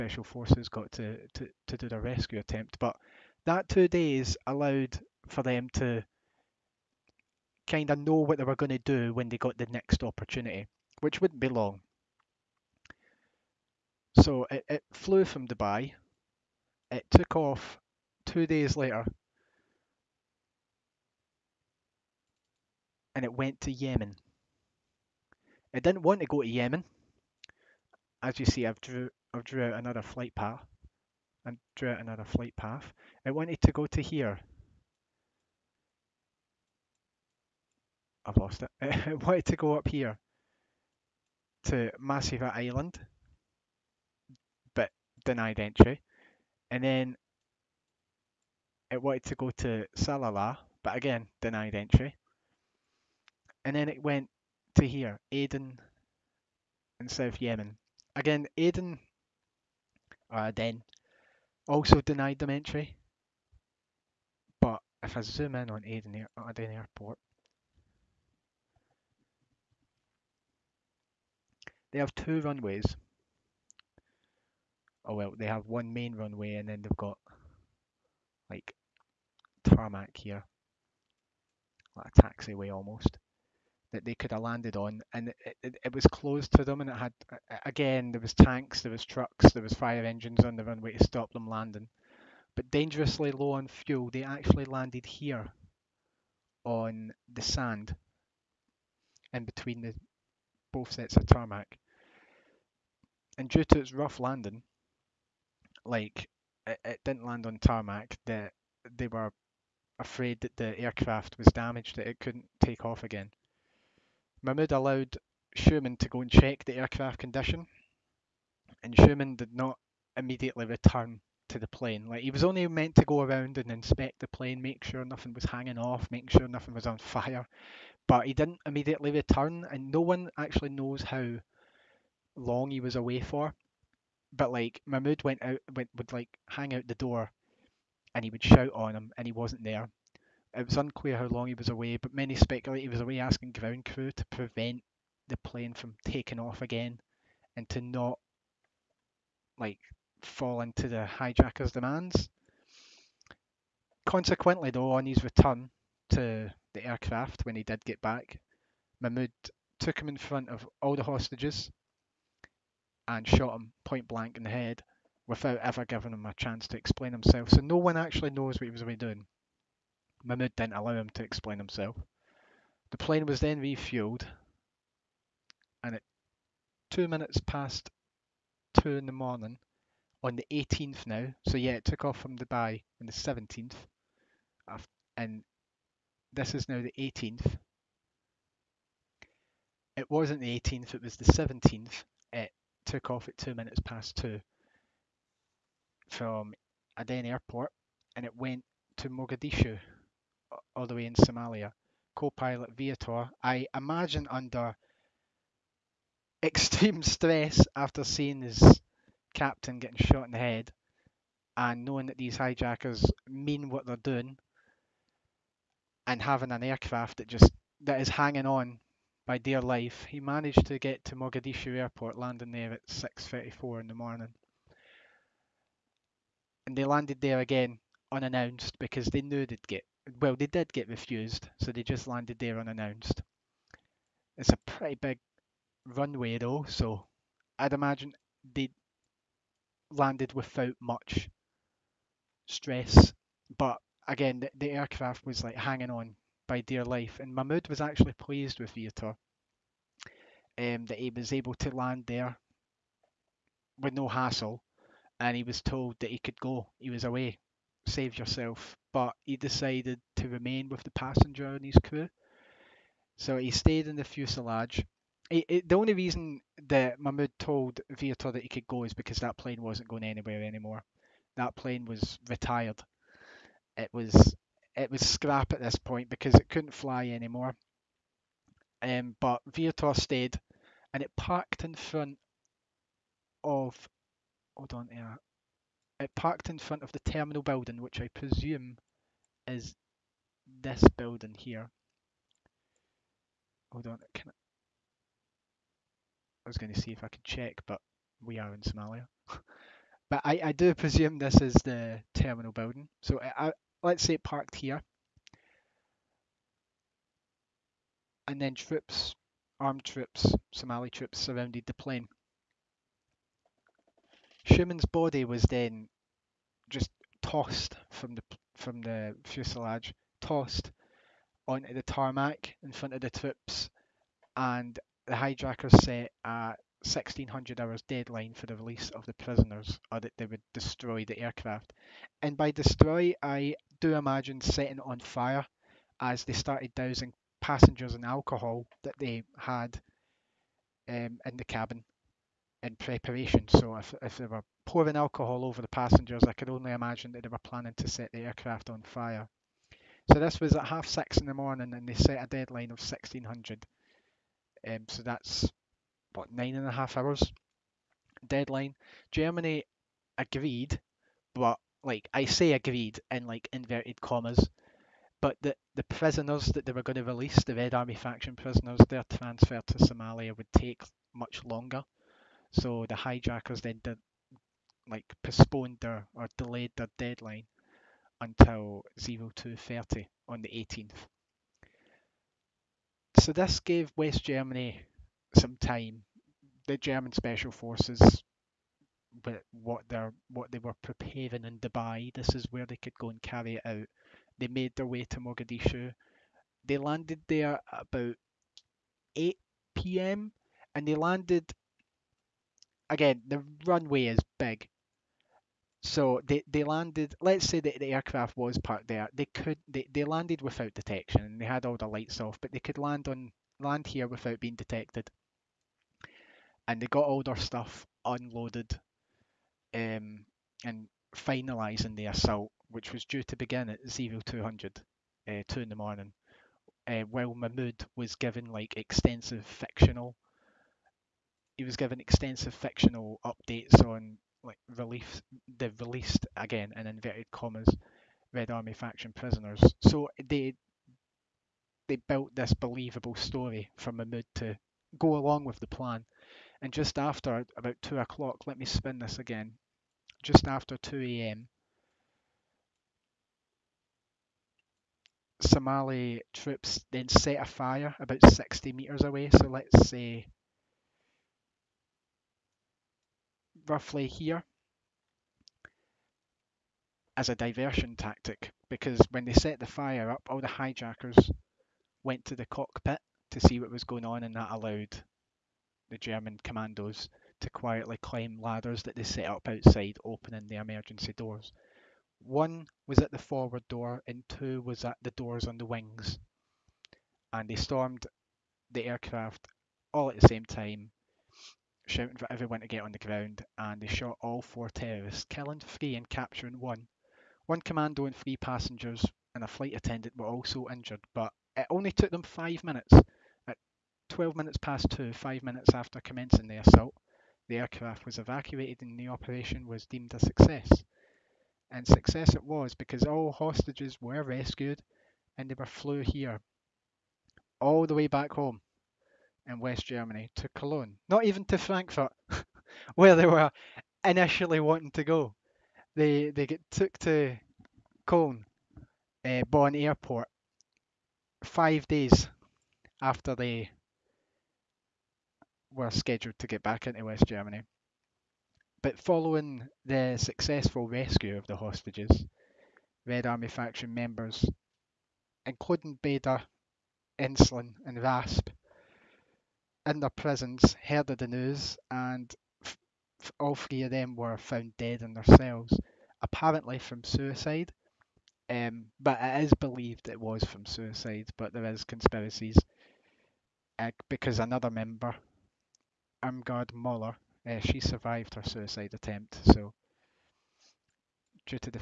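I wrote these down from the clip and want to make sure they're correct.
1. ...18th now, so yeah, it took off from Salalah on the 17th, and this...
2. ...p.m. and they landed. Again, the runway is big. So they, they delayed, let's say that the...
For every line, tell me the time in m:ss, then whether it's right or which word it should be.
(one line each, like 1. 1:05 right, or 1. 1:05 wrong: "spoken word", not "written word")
1. 3:00 wrong: "Dubai", not "Salalah"
2. 6:39 wrong: "landed", not "delayed".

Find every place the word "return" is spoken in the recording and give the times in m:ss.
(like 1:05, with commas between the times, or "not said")
2:00, 2:09, 2:35.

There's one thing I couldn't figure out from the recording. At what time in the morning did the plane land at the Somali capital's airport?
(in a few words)
6:34.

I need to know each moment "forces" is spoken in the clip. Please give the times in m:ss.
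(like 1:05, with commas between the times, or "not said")
0:00, 6:27.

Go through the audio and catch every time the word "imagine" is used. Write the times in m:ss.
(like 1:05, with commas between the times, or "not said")
3:23, 3:57, 5:33, 5:46.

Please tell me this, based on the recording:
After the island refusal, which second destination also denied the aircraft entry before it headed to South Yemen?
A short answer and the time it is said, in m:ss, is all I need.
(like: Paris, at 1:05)
Salalah, at 0:49.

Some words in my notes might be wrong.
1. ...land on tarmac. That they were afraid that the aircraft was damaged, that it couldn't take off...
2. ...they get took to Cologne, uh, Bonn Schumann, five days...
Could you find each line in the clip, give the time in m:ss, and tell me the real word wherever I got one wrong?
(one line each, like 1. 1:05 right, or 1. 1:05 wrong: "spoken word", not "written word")
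1. 1:47 right
2. 8:46 wrong: "Airport", not "Schumann".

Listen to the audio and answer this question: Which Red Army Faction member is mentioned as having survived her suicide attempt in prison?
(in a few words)
Irmgard Muller.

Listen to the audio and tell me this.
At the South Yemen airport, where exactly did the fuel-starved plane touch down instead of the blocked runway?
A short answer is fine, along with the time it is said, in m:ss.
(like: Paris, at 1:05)
On the sand, at 1:36.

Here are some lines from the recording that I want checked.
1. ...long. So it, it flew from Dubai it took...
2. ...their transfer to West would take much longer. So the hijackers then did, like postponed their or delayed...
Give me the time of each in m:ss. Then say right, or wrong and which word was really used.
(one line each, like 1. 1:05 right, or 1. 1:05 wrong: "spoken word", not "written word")
1. 0:11 right
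2. 6:08 wrong: "Somalia", not "West".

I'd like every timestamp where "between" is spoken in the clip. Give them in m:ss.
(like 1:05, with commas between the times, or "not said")
1:39.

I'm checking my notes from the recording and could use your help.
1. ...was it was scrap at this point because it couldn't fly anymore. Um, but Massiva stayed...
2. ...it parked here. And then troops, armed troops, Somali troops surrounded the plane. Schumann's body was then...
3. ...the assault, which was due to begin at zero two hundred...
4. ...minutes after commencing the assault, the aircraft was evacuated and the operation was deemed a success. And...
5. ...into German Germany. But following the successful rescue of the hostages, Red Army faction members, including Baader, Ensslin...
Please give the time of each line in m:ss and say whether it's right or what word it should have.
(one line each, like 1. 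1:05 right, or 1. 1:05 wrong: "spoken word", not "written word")
1. 4:33 wrong: "Vietor", not "Massiva"
2. 5:04 right
3. 7:01 right
4. 8:25 right
5. 8:56 wrong: "West", not "German".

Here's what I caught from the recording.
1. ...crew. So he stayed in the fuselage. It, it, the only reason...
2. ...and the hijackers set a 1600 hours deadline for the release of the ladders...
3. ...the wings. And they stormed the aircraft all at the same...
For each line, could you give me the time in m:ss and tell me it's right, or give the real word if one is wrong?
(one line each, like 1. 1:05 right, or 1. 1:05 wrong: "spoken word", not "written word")
1. 4:21 right
2. 5:24 wrong: "prisoners", not "ladders"
3. 8:05 right.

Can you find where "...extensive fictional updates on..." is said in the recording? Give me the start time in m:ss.
7:11.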